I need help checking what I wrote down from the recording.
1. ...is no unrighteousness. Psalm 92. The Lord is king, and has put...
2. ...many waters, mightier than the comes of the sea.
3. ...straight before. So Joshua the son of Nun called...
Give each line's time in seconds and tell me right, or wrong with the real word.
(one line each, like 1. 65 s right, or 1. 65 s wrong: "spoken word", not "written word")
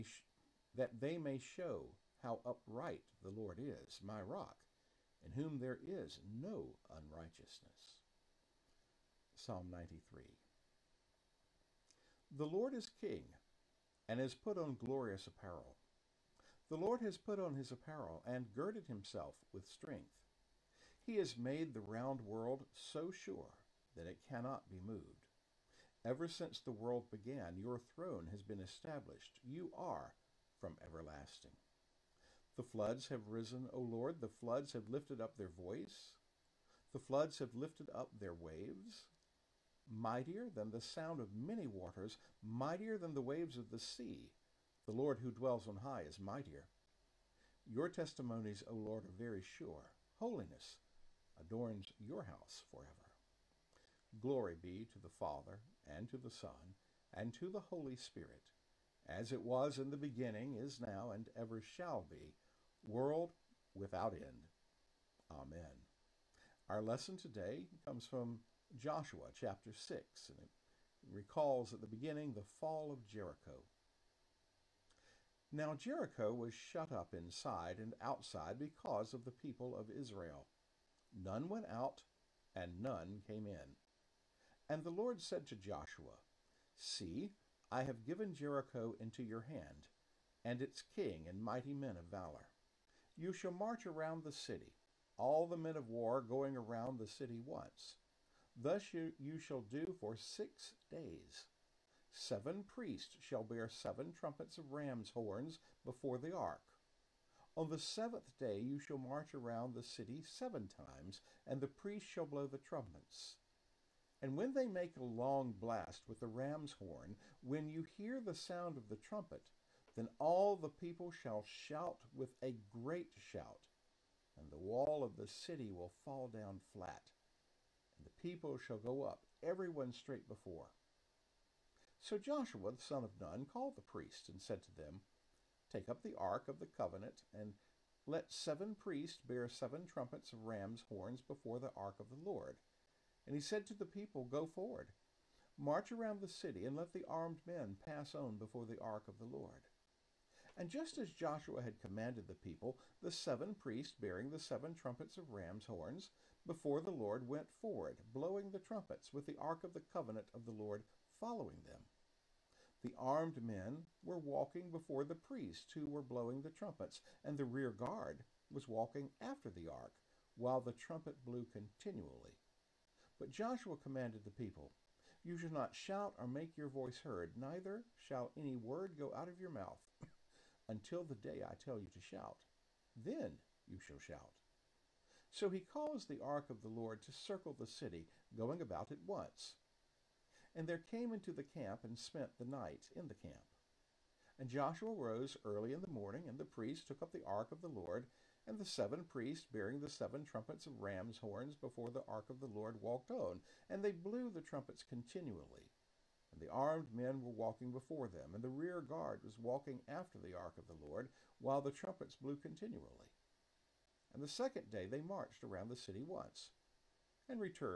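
1. 5 s wrong: "93", not "92"
2. 41 s wrong: "waves", not "comes"
3. 129 s right.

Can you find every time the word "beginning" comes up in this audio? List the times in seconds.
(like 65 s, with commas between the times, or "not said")
59 s, 71 s.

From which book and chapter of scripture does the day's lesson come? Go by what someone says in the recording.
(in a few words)
Joshua 6.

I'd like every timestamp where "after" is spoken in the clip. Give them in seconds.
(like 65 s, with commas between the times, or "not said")
169 s, 209 s.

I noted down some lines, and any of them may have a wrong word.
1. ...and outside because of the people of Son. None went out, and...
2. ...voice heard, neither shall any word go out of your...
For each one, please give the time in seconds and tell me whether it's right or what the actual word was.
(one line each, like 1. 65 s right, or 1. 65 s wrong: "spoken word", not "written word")
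1. 77 s wrong: "Israel", not "Son"
2. 176 s right.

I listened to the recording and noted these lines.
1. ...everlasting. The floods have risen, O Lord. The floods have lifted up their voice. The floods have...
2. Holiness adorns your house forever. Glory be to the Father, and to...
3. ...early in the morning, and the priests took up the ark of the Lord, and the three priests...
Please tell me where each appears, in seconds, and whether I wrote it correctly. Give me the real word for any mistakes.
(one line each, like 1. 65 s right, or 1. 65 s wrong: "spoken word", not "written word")
1. 30 s right
2. 50 s right
3. 195 s wrong: "seven", not "three".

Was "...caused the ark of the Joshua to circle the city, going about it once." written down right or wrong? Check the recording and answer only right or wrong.
wrong.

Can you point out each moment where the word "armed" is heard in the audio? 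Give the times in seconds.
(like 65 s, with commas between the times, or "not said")
147 s, 162 s, 206 s.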